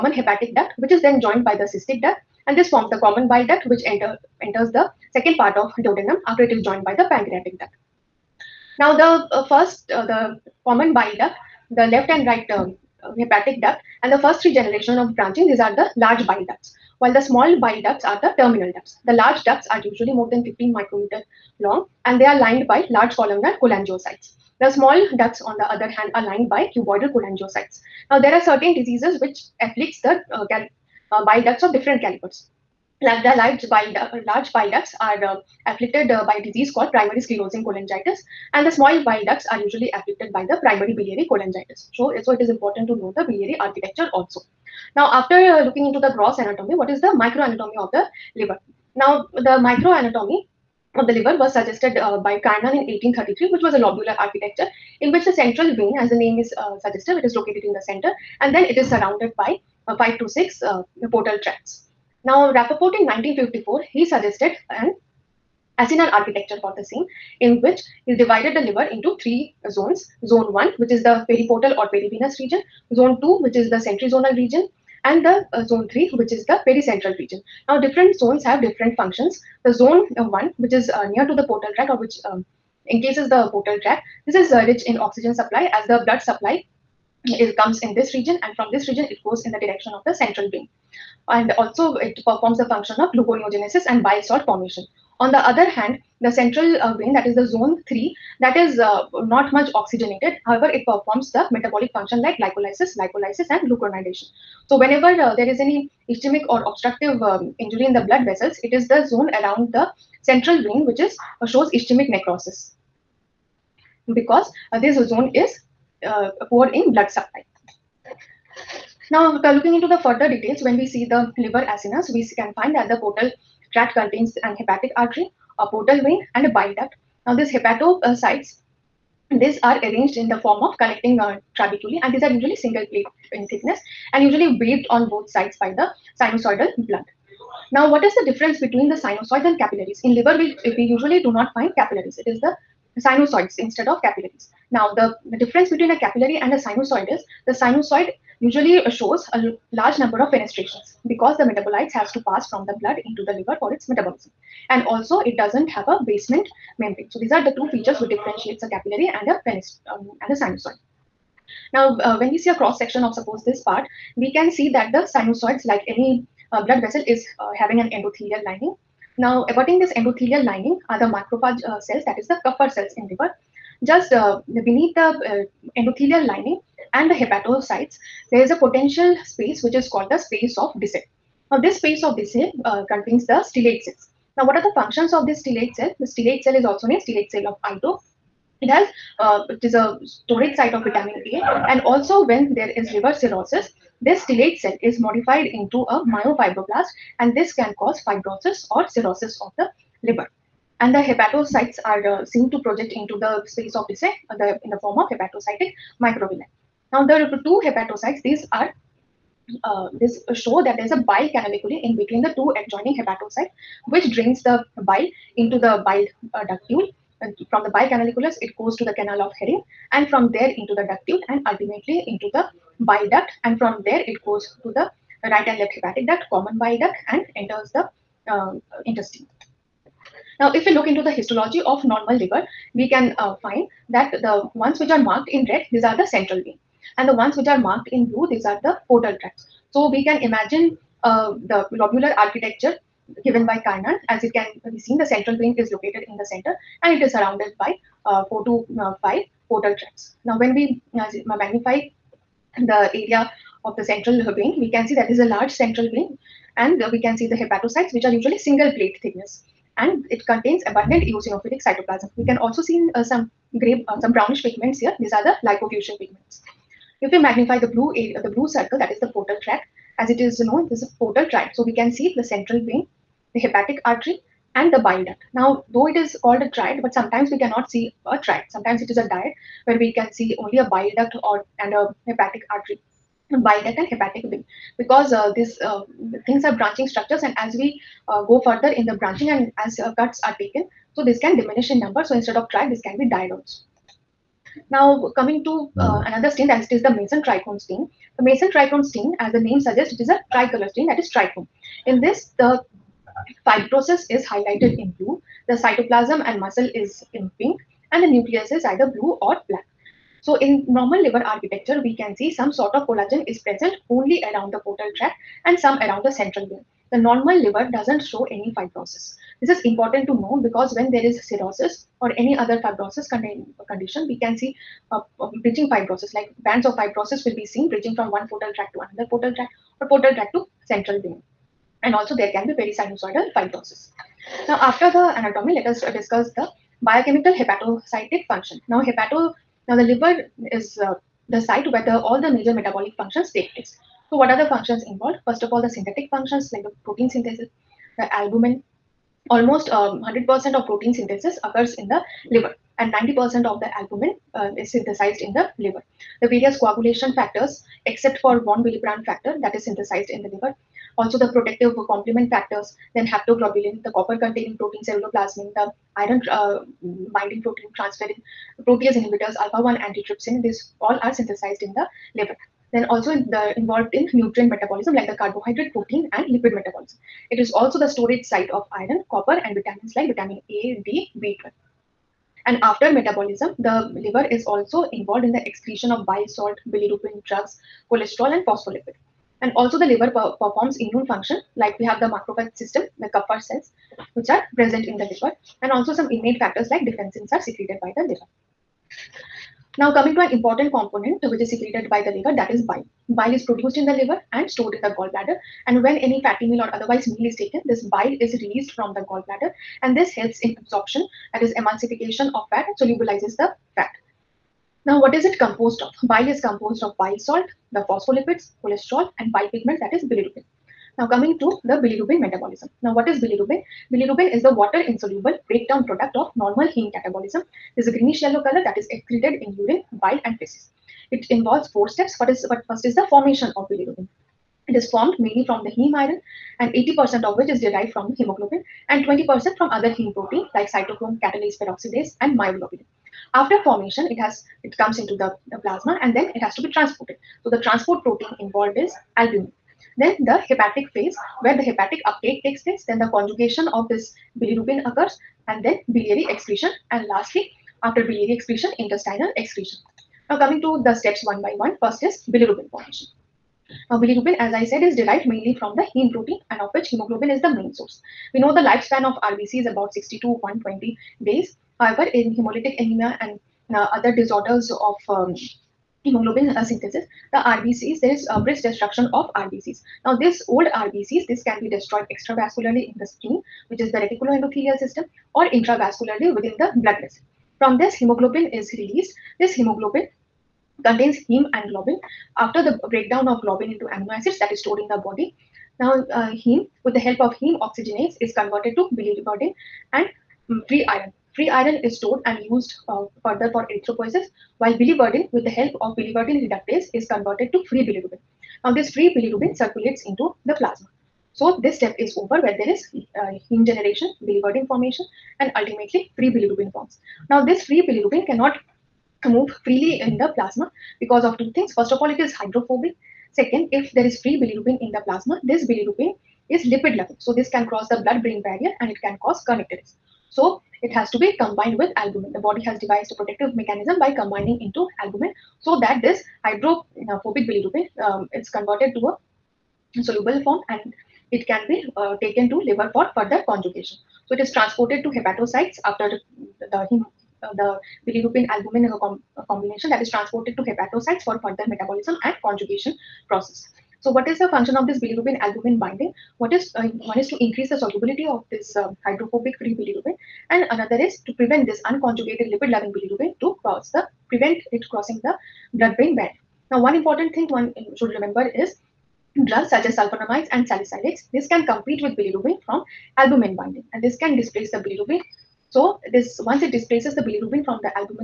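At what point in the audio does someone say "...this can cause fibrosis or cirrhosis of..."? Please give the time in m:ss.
3:17.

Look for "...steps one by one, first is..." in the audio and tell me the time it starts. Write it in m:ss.
7:40.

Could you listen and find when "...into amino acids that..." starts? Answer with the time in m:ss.
8:13.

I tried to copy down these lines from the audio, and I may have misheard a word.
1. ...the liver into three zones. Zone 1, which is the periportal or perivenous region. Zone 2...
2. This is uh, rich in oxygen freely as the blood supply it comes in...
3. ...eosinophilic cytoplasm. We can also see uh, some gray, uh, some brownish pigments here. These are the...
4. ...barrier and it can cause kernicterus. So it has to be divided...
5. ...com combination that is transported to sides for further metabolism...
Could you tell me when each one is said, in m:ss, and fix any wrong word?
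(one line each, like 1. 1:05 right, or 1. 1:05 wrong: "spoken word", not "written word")
1. 1:08 right
2. 1:24 wrong: "supply", not "freely"
3. 4:21 right
4. 8:48 wrong: "combined", not "divided"
5. 9:09 wrong: "hepatocytes", not "sides".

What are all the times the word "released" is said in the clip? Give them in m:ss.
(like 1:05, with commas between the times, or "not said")
6:48, 8:08.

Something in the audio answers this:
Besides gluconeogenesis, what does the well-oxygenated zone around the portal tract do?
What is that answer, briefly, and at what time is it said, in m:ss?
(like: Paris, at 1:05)
Bile salt formation, at 1:34.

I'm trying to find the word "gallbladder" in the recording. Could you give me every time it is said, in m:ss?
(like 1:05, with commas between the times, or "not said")
6:44, 6:49.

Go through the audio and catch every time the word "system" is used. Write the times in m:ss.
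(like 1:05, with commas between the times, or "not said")
6:32, 8:04.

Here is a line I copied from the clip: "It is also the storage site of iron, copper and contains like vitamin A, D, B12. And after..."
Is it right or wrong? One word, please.
wrong.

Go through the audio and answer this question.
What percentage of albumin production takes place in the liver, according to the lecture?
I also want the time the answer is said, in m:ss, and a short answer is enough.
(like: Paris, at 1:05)
90%, at 5:52.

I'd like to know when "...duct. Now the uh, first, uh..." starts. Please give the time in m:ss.
0:07.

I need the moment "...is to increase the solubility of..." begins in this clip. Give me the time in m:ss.
9:17.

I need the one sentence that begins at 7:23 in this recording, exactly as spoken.
After formation, it has it comes into the, the plasma and then it has to be transported.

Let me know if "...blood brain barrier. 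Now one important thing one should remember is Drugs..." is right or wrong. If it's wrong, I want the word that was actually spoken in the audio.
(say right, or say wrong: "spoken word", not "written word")
right.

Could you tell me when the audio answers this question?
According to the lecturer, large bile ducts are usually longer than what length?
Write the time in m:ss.
0:20.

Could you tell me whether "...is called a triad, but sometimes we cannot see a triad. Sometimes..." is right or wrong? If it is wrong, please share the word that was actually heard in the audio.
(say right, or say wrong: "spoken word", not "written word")
right.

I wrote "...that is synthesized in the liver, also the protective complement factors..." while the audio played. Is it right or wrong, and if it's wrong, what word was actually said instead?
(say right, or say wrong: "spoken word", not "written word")
right.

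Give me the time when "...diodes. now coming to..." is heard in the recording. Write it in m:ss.
4:53.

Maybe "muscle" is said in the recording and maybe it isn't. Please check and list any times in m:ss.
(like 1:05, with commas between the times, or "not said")
5:06.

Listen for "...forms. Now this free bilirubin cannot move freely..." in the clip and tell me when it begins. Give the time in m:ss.
8:36.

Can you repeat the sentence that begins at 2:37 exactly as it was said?
So these are the two features which differentiates a capillary and a penis um, and a sinusoid.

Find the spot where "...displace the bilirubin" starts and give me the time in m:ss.
9:34.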